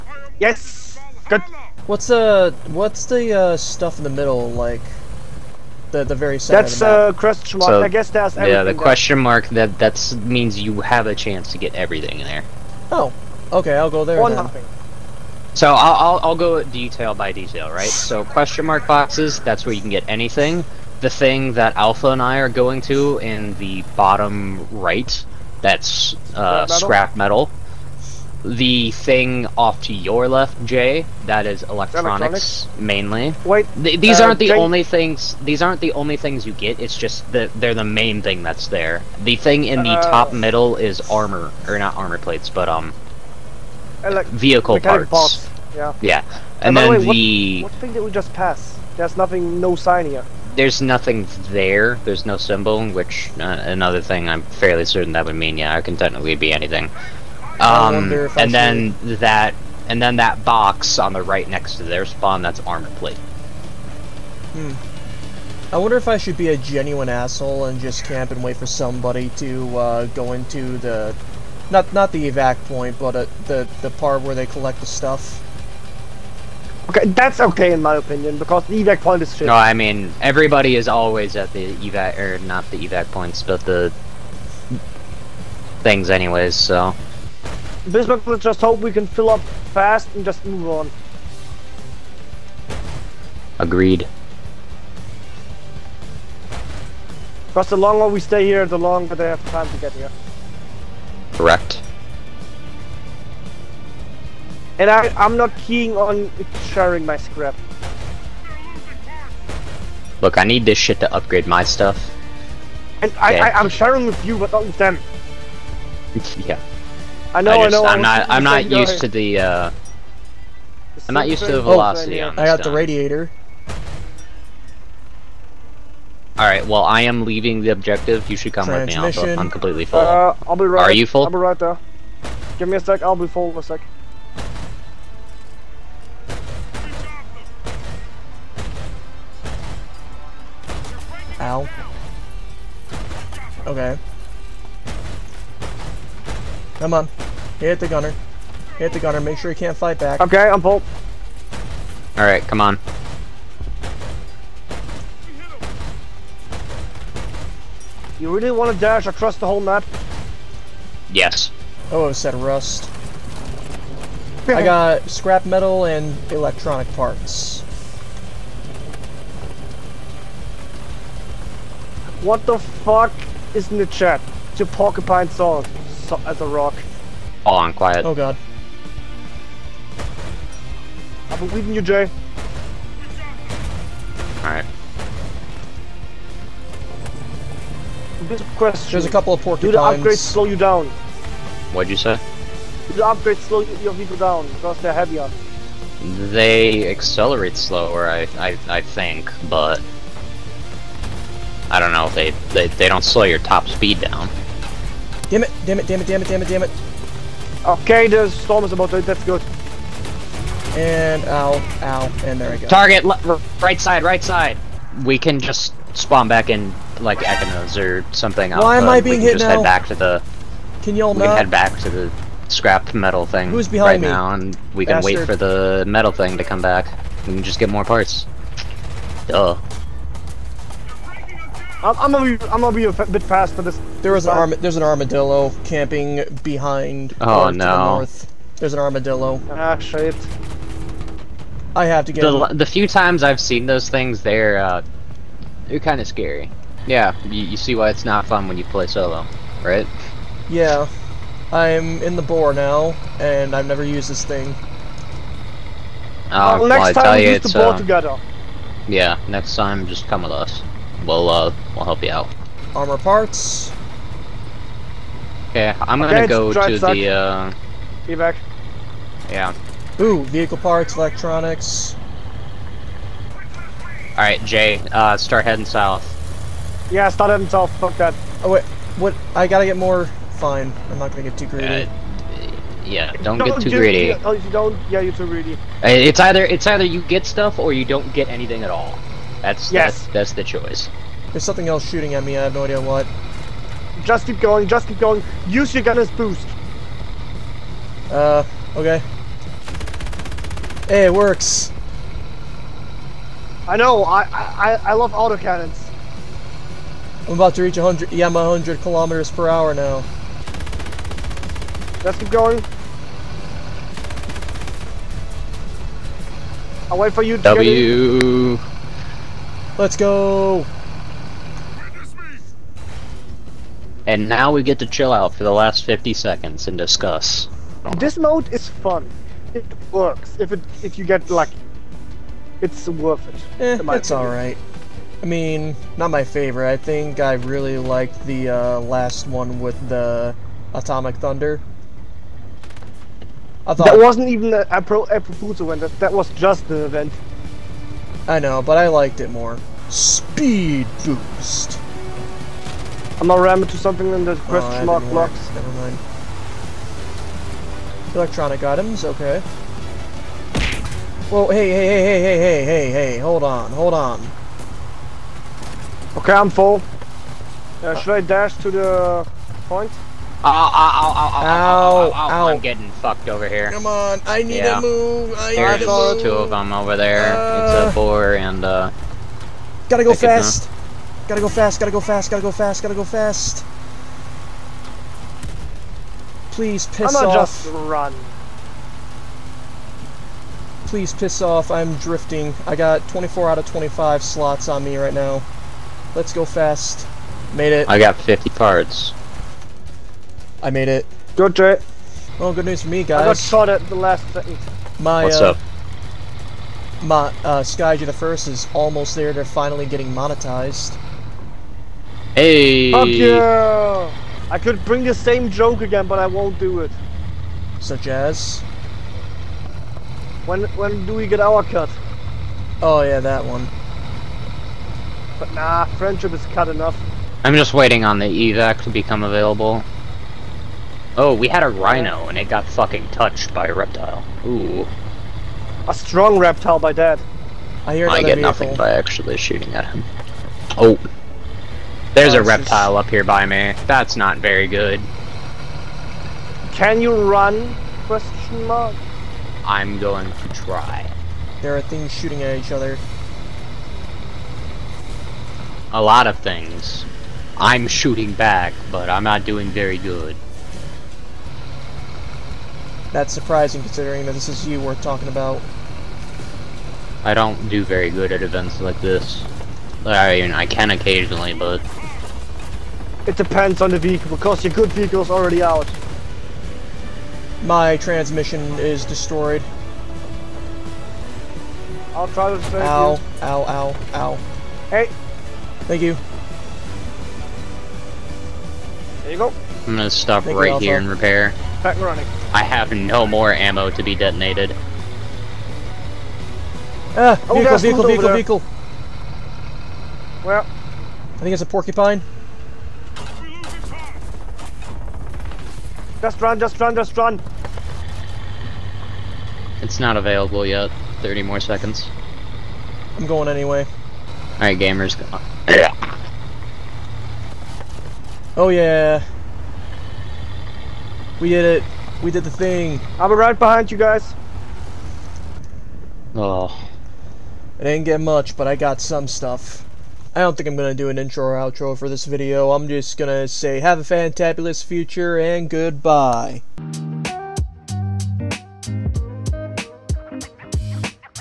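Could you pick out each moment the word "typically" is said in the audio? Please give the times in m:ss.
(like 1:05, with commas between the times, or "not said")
not said.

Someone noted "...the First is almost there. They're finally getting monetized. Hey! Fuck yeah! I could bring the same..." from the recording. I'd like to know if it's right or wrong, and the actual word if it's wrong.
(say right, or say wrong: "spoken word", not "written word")
right.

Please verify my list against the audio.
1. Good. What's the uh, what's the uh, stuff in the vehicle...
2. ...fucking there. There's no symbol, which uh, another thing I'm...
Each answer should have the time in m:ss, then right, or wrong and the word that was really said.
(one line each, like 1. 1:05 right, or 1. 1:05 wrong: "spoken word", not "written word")
1. 0:01 wrong: "middle", not "vehicle"
2. 0:50 wrong: "nothing", not "fucking".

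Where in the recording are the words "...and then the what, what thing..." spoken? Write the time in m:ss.
0:46.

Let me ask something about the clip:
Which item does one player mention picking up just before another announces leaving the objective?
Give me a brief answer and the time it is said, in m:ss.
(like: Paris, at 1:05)
Radiator, at 2:02.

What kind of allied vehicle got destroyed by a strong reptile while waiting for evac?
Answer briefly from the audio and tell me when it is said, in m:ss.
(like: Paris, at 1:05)
Rhino, at 7:11.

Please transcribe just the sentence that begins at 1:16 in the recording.
Okay, that's okay in my opinion because the evac point is shit.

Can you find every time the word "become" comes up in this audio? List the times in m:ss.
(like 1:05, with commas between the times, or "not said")
7:08.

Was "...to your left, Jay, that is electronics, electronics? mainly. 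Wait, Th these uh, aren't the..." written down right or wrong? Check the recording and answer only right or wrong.
right.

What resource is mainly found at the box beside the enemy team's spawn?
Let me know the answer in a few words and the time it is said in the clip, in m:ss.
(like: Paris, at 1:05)
Armor plate, at 1:02.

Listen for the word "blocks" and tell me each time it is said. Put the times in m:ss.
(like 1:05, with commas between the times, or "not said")
5:55.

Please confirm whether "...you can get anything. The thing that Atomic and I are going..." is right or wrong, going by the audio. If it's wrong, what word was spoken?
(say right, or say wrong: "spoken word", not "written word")
wrong: "Alpha", not "Atomic".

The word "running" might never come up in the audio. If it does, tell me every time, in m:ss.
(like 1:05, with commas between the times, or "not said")
8:11.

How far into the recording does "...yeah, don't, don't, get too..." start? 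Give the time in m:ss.
4:42.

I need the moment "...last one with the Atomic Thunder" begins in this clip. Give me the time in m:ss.
5:38.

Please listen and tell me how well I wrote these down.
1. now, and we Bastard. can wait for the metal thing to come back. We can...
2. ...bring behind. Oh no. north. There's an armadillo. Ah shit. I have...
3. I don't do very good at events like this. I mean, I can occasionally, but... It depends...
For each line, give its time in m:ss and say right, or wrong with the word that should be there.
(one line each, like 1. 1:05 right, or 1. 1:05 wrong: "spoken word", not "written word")
1. 3:44 right
2. 3:55 wrong: "camping", not "bring"
3. 7:47 right.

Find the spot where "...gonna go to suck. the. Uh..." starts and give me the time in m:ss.
4:25.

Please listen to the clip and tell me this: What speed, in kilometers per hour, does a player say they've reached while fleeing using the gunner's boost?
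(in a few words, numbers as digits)
100.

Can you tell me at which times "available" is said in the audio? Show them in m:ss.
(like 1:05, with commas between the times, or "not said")
7:09, 8:30.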